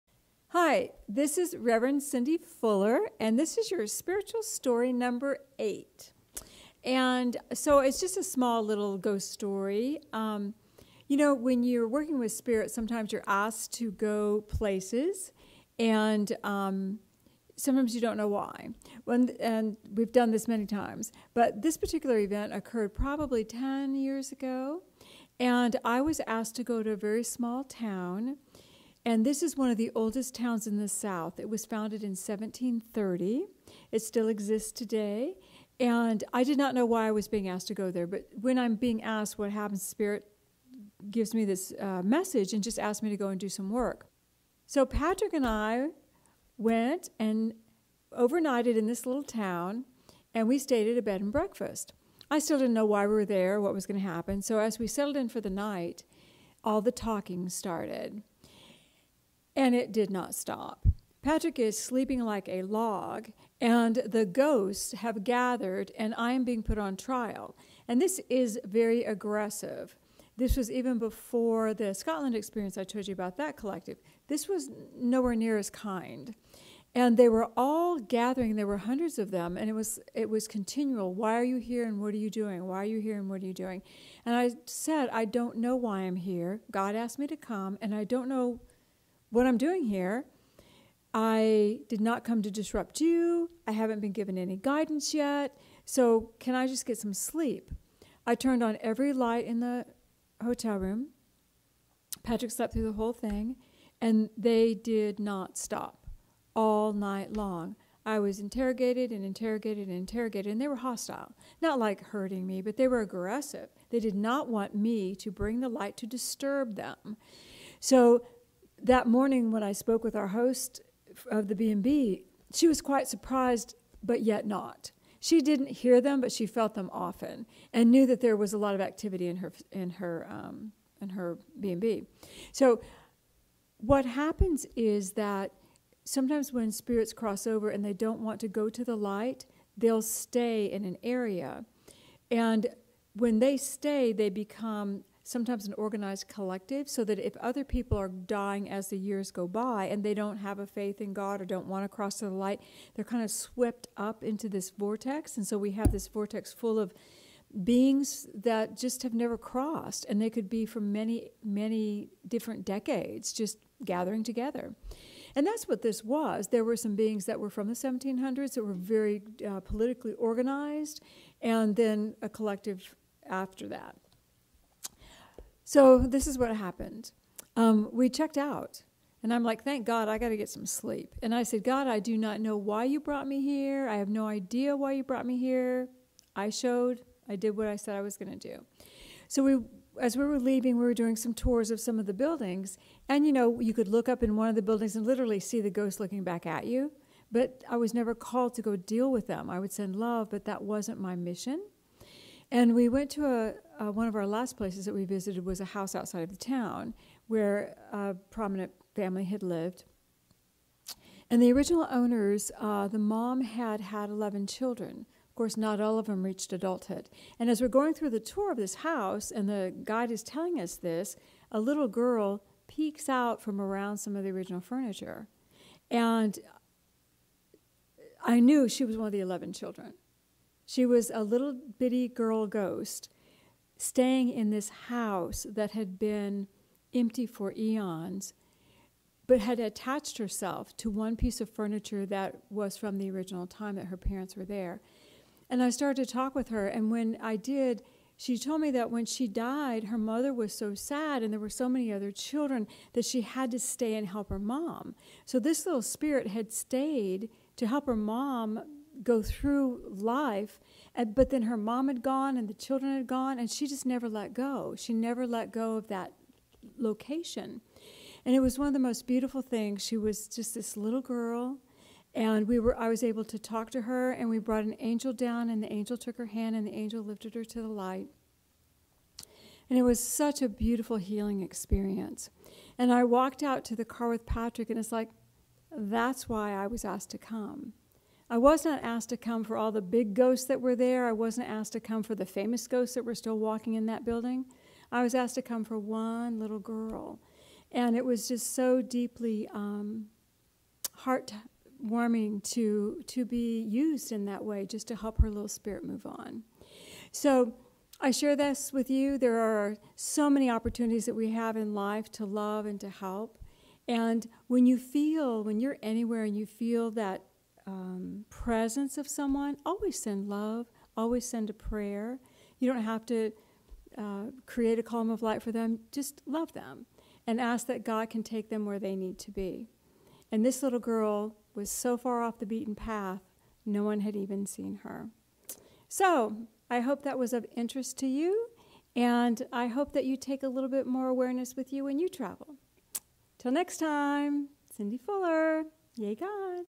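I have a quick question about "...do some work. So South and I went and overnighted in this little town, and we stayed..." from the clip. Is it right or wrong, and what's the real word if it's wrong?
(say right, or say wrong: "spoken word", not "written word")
wrong: "Patrick", not "South".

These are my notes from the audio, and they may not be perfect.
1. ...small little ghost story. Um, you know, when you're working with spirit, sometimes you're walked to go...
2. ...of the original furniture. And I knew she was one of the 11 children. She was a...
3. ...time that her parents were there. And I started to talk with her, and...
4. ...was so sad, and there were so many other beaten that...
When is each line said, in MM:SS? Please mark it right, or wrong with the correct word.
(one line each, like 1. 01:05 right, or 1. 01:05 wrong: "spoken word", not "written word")
1. 00:08 wrong: "asked", not "walked"
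2. 03:44 right
3. 04:03 right
4. 04:10 wrong: "children", not "beaten".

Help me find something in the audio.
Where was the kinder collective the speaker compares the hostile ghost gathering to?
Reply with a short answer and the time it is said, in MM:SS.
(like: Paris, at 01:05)
Scotland, at 01:11.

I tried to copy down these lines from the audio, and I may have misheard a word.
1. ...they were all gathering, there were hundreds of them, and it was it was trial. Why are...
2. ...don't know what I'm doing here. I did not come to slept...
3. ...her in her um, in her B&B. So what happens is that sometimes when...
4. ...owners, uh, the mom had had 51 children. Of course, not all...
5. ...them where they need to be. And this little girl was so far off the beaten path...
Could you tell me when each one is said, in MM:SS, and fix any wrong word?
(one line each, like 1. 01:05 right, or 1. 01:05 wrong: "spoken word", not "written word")
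1. 01:17 wrong: "continual", not "trial"
2. 01:28 wrong: "disrupt", not "slept"
3. 02:09 right
4. 03:31 wrong: "11", not "51"
5. 05:28 right.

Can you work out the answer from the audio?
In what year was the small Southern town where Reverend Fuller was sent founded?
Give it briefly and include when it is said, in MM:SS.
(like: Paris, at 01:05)
1730, at 00:32.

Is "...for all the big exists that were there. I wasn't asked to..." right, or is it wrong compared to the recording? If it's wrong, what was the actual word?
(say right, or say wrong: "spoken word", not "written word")
wrong: "ghosts", not "exists".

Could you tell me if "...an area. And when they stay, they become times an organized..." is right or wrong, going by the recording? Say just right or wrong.
wrong.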